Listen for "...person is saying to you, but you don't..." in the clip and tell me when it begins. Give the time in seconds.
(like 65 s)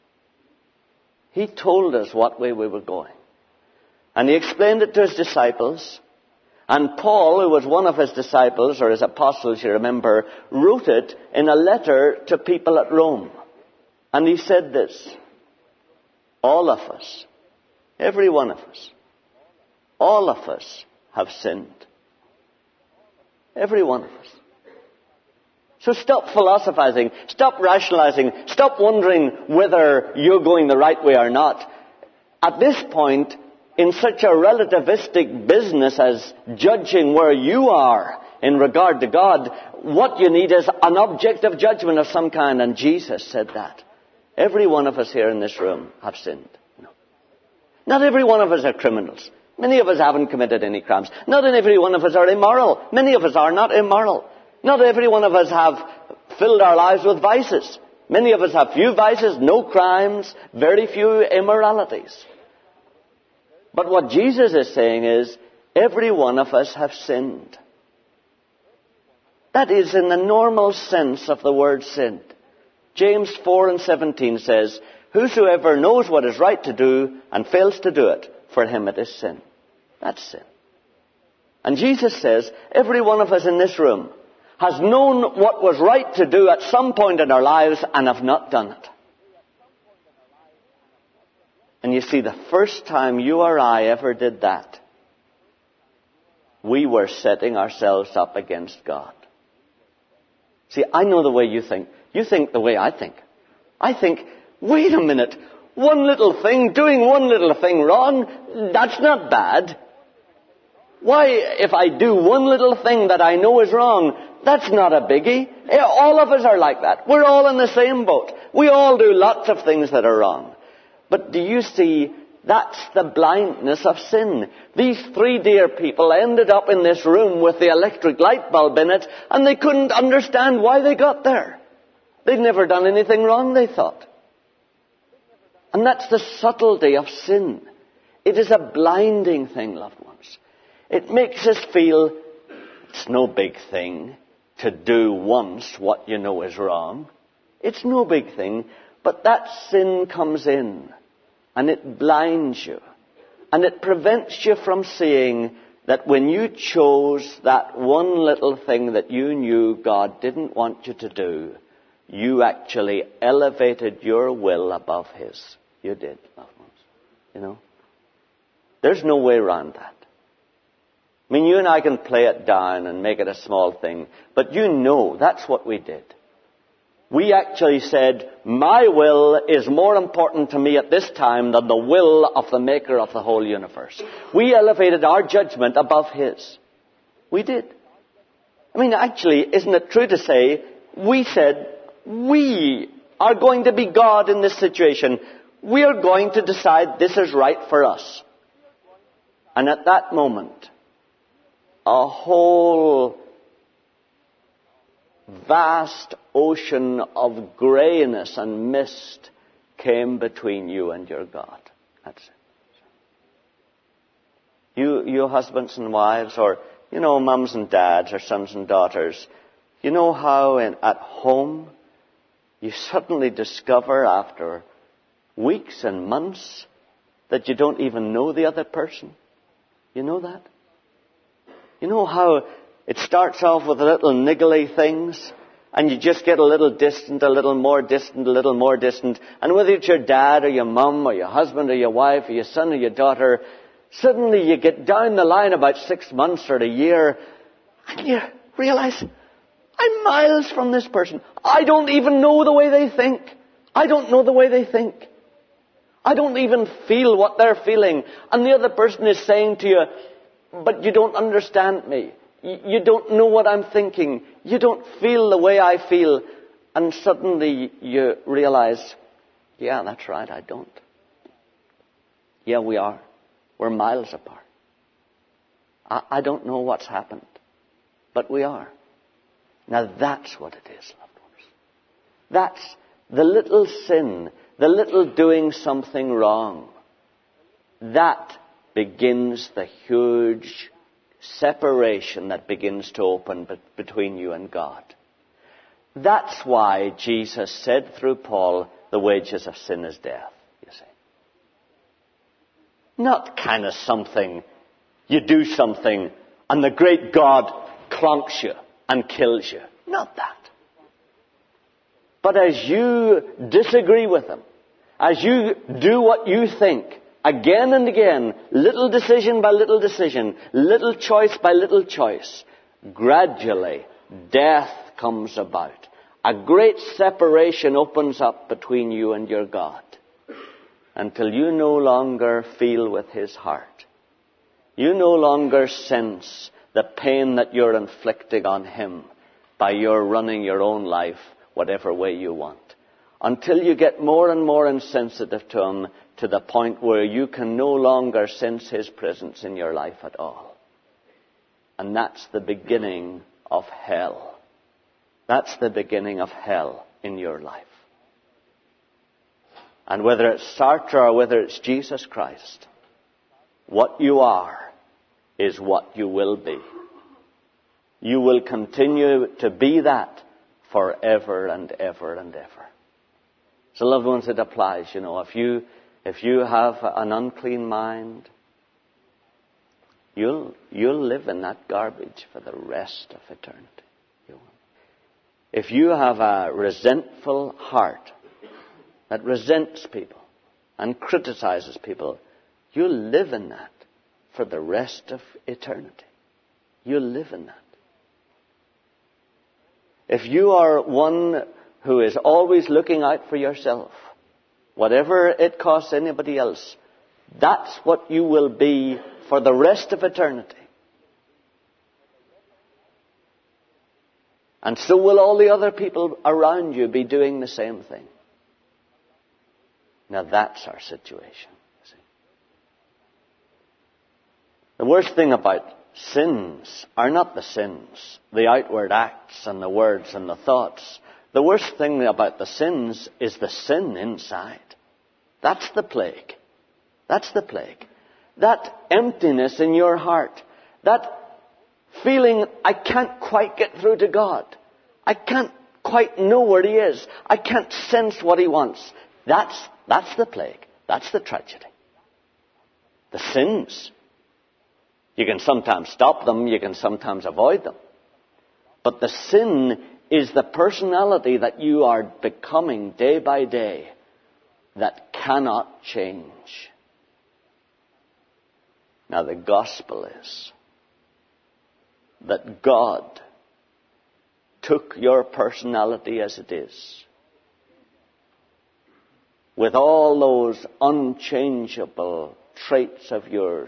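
258 s.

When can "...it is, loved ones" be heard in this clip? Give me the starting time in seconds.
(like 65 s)
280 s.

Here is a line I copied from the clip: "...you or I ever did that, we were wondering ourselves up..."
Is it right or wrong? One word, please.
wrong.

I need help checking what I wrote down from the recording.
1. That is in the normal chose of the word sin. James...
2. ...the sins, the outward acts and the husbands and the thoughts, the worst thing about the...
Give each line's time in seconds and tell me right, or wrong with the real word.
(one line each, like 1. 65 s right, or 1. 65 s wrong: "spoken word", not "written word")
1. 69 s wrong: "sense", not "chose"
2. 427 s wrong: "words", not "husbands".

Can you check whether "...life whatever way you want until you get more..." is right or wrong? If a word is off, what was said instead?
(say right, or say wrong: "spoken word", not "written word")
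right.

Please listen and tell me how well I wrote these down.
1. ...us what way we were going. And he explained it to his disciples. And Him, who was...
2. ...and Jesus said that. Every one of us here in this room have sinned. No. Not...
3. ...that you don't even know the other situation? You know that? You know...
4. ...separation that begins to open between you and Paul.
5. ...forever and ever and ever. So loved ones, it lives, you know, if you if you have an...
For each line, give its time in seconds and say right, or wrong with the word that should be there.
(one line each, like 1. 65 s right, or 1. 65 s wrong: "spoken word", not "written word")
1. 1 s wrong: "Paul", not "Him"
2. 42 s right
3. 227 s wrong: "person", not "situation"
4. 291 s wrong: "God", not "Paul"
5. 370 s wrong: "applies", not "lives".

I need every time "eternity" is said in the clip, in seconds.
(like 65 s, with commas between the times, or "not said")
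383 s, 395 s, 410 s.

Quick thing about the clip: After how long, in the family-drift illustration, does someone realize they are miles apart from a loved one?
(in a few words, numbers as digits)
six months or a year.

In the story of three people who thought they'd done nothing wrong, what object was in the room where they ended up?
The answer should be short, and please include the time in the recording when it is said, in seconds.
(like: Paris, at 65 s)
electric light bulb, at 127 s.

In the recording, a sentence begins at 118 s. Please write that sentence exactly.
We all do lots of things that are wrong.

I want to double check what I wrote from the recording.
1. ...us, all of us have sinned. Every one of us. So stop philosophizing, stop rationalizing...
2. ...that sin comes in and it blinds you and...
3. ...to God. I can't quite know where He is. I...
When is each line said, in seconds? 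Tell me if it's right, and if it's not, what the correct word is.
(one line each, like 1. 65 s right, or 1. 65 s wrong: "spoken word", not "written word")
1. 18 s right
2. 149 s right
3. 443 s right.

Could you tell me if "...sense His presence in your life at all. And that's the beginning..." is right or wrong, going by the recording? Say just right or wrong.
right.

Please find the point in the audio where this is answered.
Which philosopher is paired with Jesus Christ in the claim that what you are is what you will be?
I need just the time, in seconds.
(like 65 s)
360 s.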